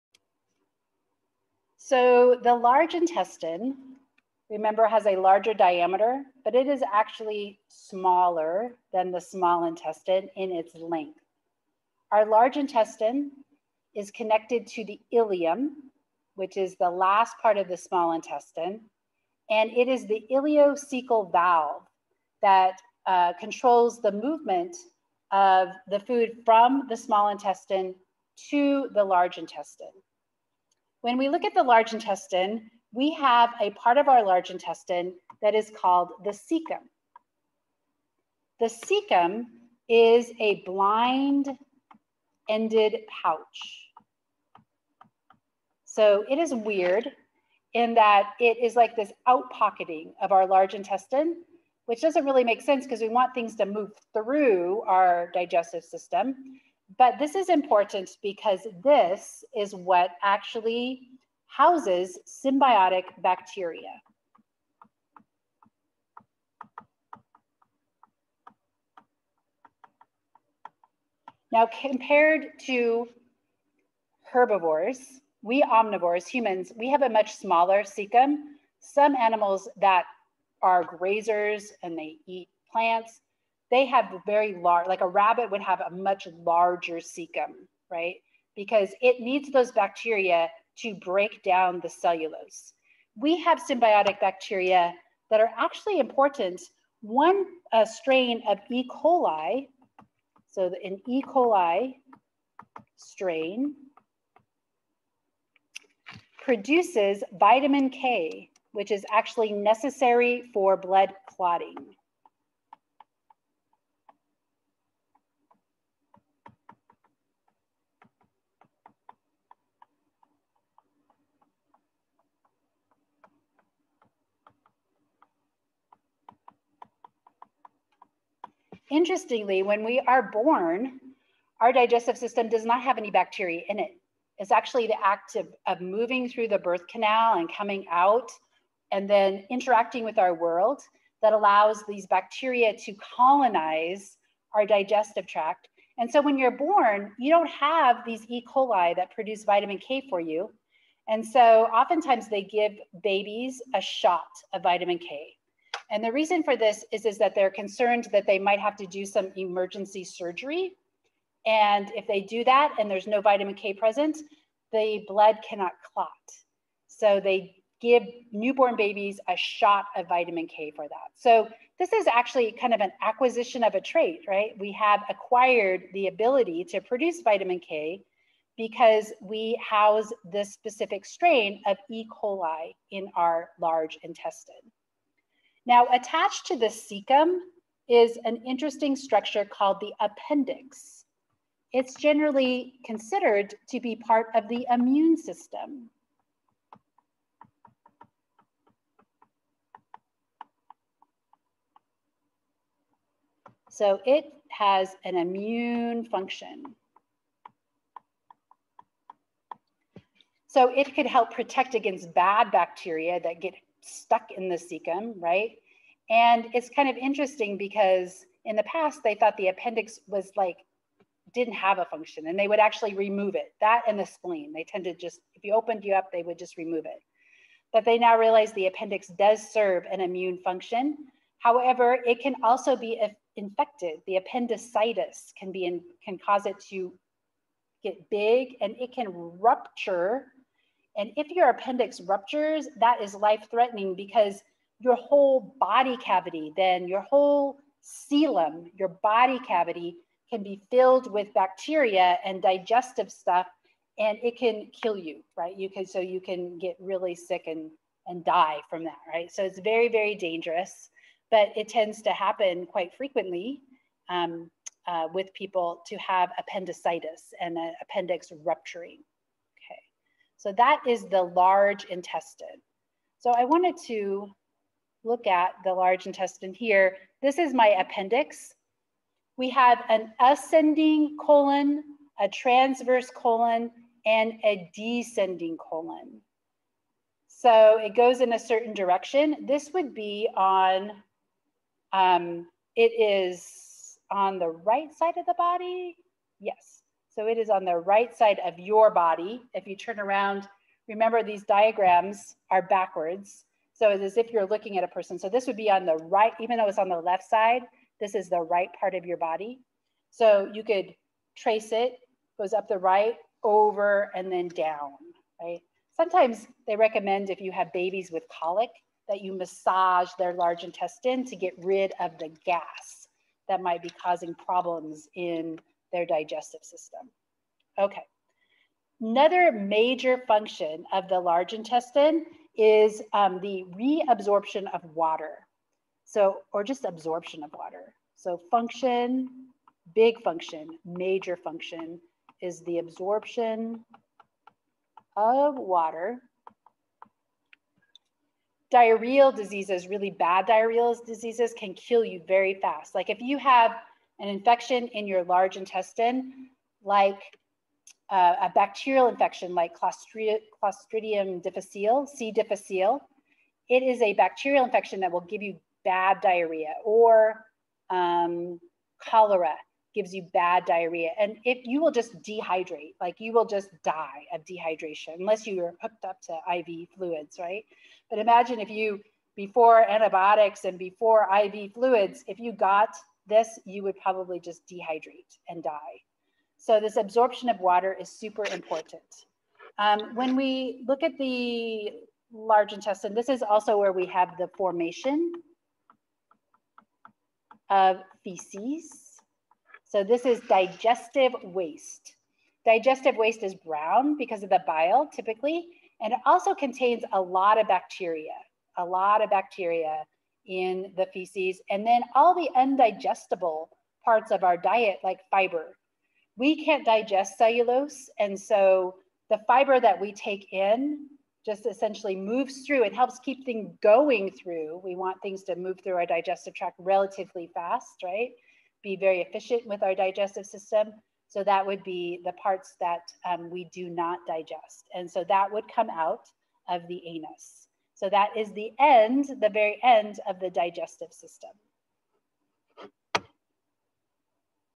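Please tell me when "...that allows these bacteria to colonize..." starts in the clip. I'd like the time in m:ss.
2:21.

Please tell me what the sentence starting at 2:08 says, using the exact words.
interestingly, when we are born, our digestive system does not have any bacteria in it.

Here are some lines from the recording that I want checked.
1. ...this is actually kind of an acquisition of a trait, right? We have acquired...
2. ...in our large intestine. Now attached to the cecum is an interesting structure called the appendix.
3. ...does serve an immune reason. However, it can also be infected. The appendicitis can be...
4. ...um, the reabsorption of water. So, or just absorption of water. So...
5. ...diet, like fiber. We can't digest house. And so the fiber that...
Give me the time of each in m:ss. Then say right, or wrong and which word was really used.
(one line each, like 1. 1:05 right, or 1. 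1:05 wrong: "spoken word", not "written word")
1. 2:51 right
2. 3:02 right
3. 3:49 wrong: "function", not "reason"
4. 5:33 right
5. 6:54 wrong: "cellulose", not "house".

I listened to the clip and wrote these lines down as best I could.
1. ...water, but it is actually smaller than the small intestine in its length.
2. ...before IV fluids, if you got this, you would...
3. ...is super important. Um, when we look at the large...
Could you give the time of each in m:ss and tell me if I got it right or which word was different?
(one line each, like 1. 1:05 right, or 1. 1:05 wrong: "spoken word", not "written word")
1. 0:05 wrong: "diameter", not "water"
2. 6:20 right
3. 6:27 right.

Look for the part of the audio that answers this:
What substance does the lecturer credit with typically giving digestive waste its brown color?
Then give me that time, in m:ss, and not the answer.
6:44.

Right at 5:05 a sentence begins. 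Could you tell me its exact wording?
So this would be on the right, even though it's on the left side, this is the right part of your body.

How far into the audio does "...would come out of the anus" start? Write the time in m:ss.
7:15.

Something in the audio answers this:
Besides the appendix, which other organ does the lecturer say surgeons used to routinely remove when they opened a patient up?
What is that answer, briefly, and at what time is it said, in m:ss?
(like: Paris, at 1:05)
spleen, at 3:44.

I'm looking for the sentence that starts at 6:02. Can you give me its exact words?
difficile, it is a bacterial infection that will give you bad diarrhea or um, cholera gives you bad diarrhea.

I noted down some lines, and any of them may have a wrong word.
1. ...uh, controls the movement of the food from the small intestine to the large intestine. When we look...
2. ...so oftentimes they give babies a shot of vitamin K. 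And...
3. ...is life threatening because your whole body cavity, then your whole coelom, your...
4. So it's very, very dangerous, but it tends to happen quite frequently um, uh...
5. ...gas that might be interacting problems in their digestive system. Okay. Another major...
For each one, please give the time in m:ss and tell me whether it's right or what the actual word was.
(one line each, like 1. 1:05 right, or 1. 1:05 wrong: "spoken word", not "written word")
1. 0:23 right
2. 2:31 right
3. 4:03 right
4. 4:19 right
5. 5:22 wrong: "causing", not "interacting".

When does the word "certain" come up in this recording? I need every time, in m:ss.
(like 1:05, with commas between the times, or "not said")
4:48.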